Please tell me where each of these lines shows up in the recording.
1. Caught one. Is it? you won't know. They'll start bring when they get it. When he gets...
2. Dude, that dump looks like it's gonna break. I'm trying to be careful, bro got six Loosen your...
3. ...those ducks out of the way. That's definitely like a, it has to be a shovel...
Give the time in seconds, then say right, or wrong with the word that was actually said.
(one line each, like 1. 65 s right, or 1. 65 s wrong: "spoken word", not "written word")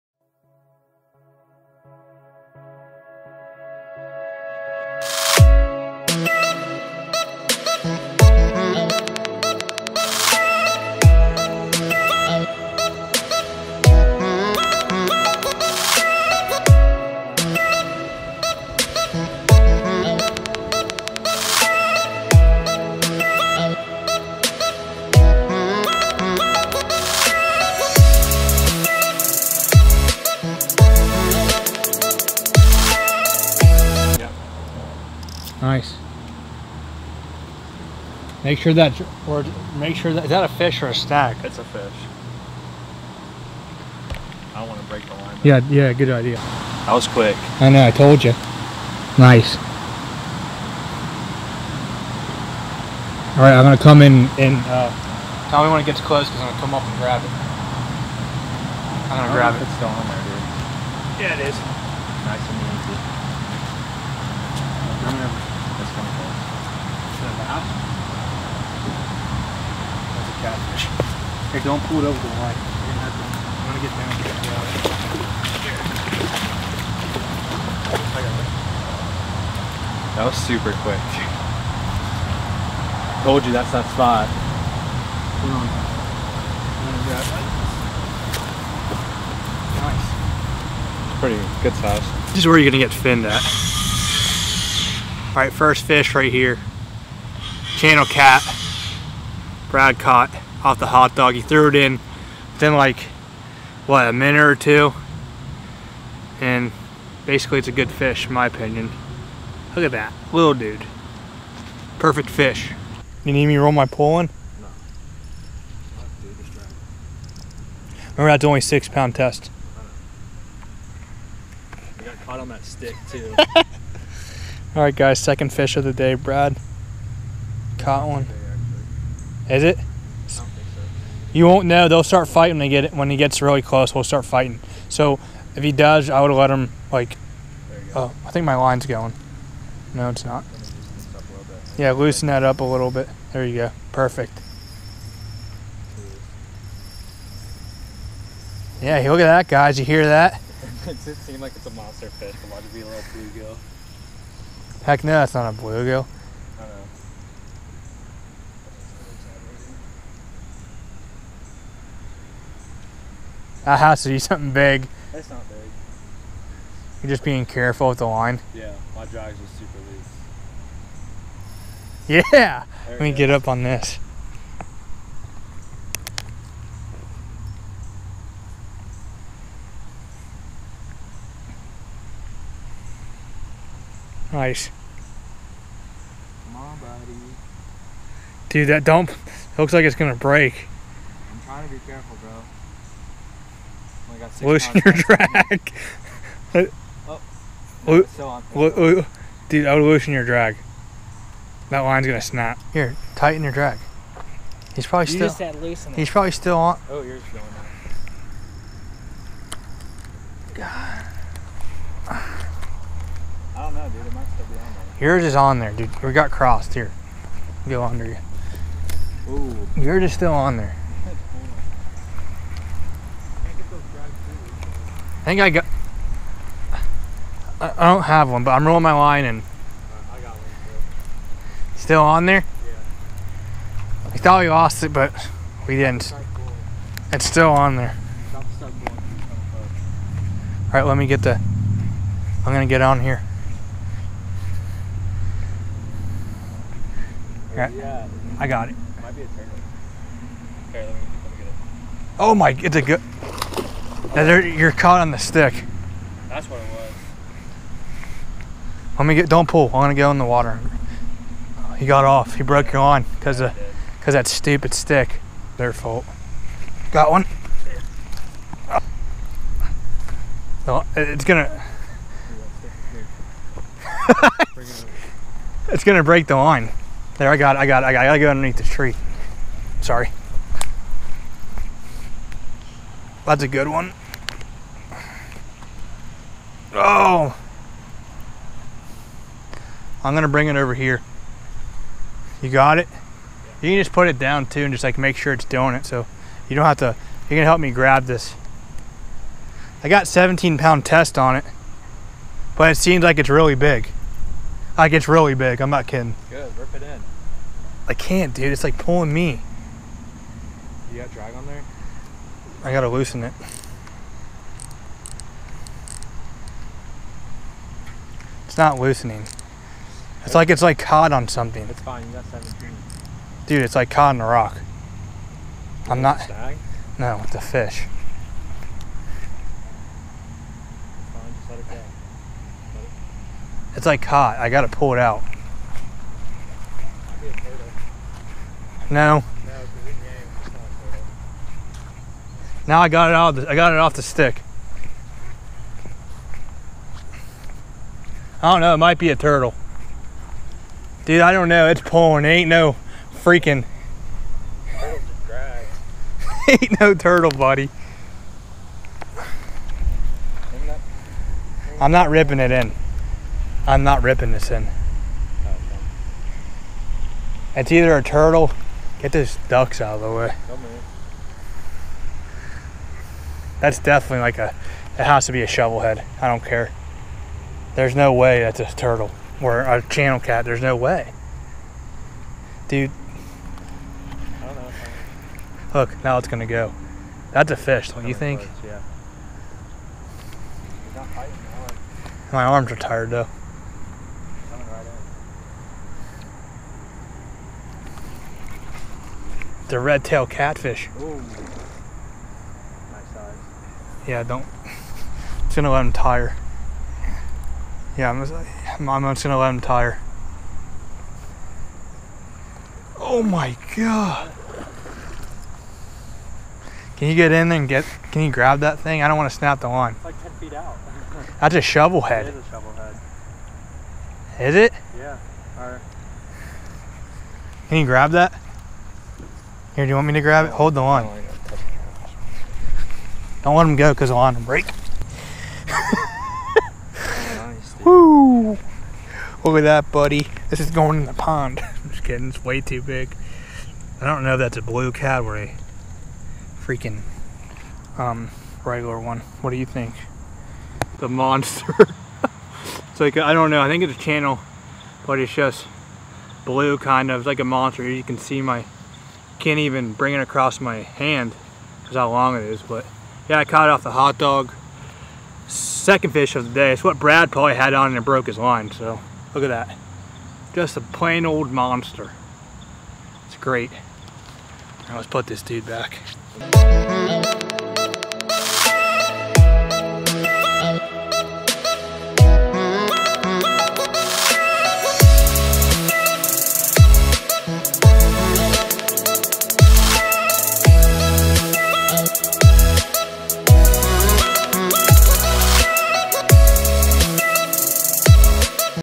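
1. 127 s wrong: "fighting", not "bring"
2. 188 s right
3. 369 s right.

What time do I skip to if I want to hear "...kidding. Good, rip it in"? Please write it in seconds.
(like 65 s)
305 s.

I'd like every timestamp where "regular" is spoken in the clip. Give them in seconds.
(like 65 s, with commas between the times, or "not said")
448 s.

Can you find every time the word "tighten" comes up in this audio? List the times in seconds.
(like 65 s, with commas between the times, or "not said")
203 s.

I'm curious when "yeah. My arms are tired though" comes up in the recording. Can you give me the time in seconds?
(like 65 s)
388 s.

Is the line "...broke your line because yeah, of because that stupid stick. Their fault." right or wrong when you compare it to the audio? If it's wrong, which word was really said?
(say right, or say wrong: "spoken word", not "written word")
right.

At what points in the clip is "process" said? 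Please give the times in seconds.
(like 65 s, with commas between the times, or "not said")
not said.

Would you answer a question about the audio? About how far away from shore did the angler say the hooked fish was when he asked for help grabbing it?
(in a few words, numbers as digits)
10 feet.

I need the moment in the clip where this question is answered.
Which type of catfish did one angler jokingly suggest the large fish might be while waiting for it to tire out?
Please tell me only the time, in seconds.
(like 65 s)
399 s.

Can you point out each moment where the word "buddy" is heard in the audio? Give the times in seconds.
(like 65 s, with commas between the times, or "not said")
186 s, 357 s, 439 s.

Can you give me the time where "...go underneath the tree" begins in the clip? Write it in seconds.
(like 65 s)
278 s.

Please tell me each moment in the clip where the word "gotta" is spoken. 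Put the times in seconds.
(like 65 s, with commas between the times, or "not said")
278 s, 312 s, 334 s.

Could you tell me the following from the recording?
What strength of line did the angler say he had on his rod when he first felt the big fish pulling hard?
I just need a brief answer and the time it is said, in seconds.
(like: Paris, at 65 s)
17 pound test, at 300 s.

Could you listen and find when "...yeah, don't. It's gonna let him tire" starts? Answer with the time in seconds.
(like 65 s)
404 s.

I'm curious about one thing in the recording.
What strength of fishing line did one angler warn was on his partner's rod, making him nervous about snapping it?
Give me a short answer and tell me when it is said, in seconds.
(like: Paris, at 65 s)
6 pound test, at 118 s.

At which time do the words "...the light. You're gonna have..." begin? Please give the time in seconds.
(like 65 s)
72 s.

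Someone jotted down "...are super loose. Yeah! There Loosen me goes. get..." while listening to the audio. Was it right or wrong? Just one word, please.
wrong.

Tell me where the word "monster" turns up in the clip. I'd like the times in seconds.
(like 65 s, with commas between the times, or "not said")
151 s, 451 s, 457 s, 471 s.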